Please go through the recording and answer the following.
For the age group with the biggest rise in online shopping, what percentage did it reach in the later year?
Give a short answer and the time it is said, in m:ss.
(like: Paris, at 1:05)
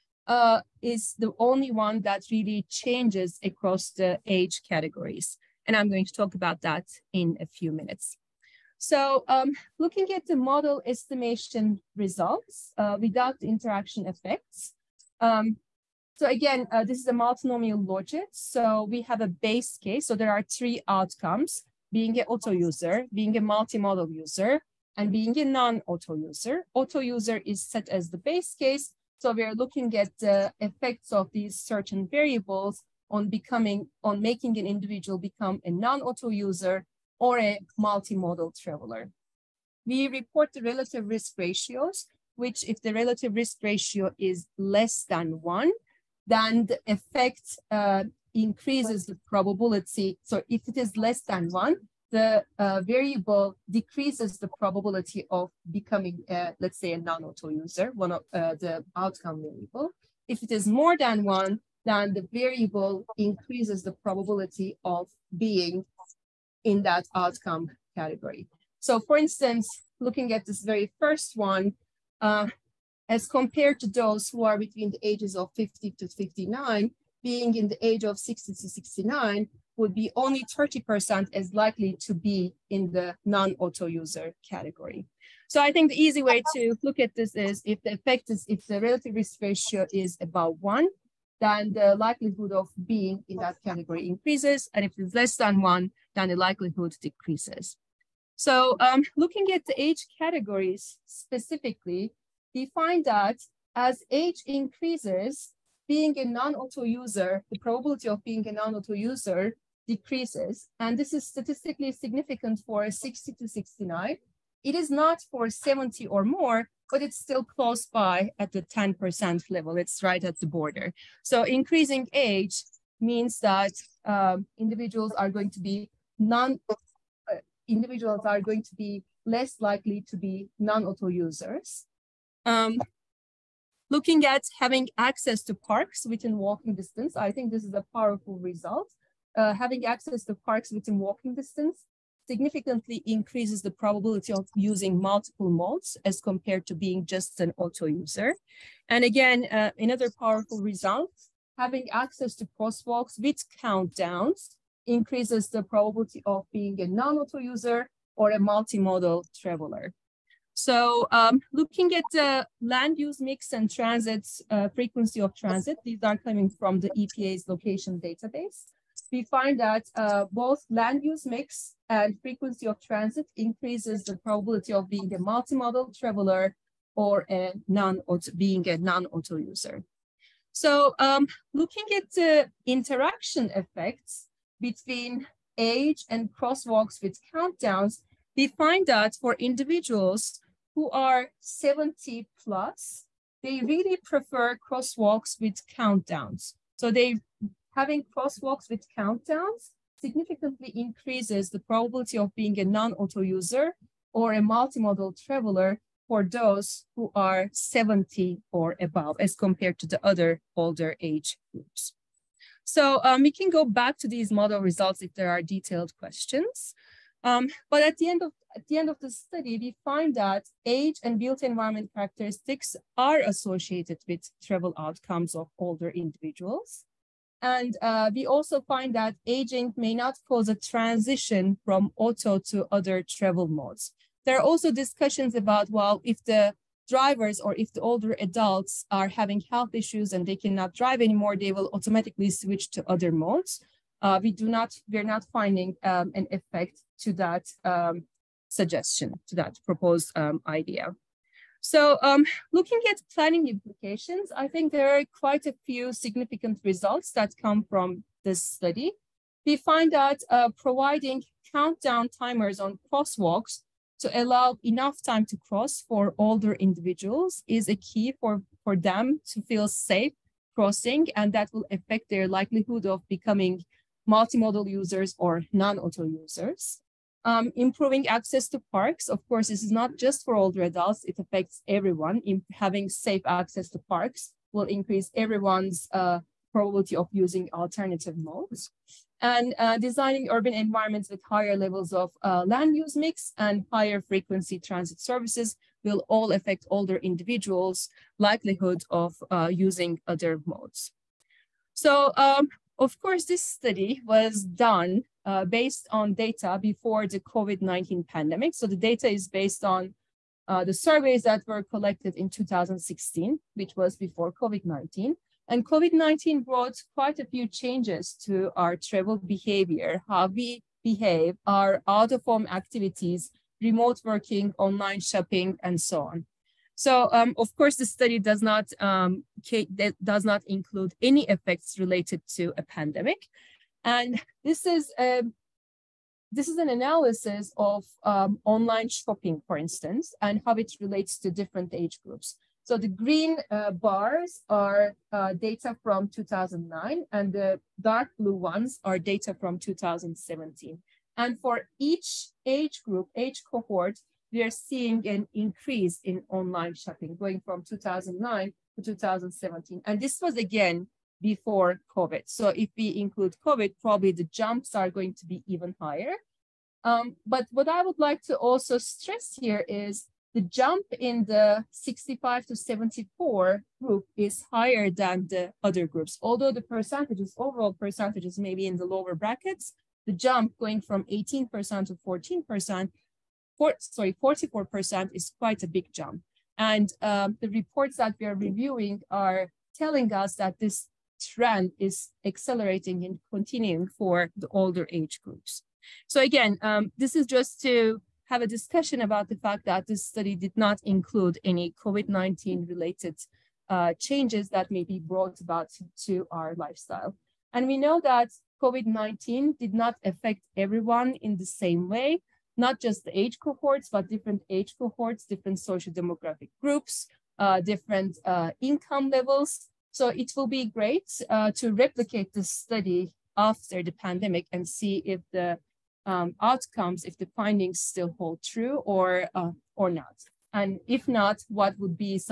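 44%, at 6:24.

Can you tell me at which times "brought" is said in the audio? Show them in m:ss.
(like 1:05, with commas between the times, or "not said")
5:16, 6:44.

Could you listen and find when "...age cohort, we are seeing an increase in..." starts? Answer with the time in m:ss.
5:53.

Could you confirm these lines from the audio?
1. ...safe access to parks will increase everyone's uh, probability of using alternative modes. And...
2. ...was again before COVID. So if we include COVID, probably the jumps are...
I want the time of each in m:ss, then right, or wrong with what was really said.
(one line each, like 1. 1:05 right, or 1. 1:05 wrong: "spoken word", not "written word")
1. 4:42 right
2. 6:00 right.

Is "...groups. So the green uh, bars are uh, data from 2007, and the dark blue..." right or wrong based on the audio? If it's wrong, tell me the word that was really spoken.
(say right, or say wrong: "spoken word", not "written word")
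wrong: "2009", not "2007".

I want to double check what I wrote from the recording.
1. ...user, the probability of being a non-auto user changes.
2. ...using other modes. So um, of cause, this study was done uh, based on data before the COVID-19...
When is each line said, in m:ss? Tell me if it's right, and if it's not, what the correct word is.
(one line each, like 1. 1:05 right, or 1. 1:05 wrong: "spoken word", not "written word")
1. 1:47 wrong: "decreases", not "changes"
2. 4:59 wrong: "course", not "cause".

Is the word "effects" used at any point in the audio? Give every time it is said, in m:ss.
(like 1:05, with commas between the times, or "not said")
0:14, 0:30, 0:46, 1:27, 3:03, 4:06, 5:31.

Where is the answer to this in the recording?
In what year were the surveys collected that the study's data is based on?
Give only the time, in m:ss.
5:12.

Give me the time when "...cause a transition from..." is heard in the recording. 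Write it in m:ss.
3:50.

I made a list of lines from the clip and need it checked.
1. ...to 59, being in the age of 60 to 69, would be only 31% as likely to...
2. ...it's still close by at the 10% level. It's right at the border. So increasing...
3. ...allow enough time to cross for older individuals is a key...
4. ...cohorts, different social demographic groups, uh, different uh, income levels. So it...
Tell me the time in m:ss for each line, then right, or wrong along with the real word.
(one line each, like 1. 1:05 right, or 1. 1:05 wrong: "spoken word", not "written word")
1. 1:15 wrong: "30", not "31"
2. 1:57 right
3. 4:24 right
4. 6:54 right.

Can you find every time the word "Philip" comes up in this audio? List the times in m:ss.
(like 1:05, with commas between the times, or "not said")
not said.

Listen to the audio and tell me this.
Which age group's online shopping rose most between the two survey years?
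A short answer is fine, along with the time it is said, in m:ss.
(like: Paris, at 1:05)
65 to 74, at 6:11.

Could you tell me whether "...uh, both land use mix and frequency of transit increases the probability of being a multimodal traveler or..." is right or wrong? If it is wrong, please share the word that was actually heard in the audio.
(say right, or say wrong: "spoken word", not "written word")
right.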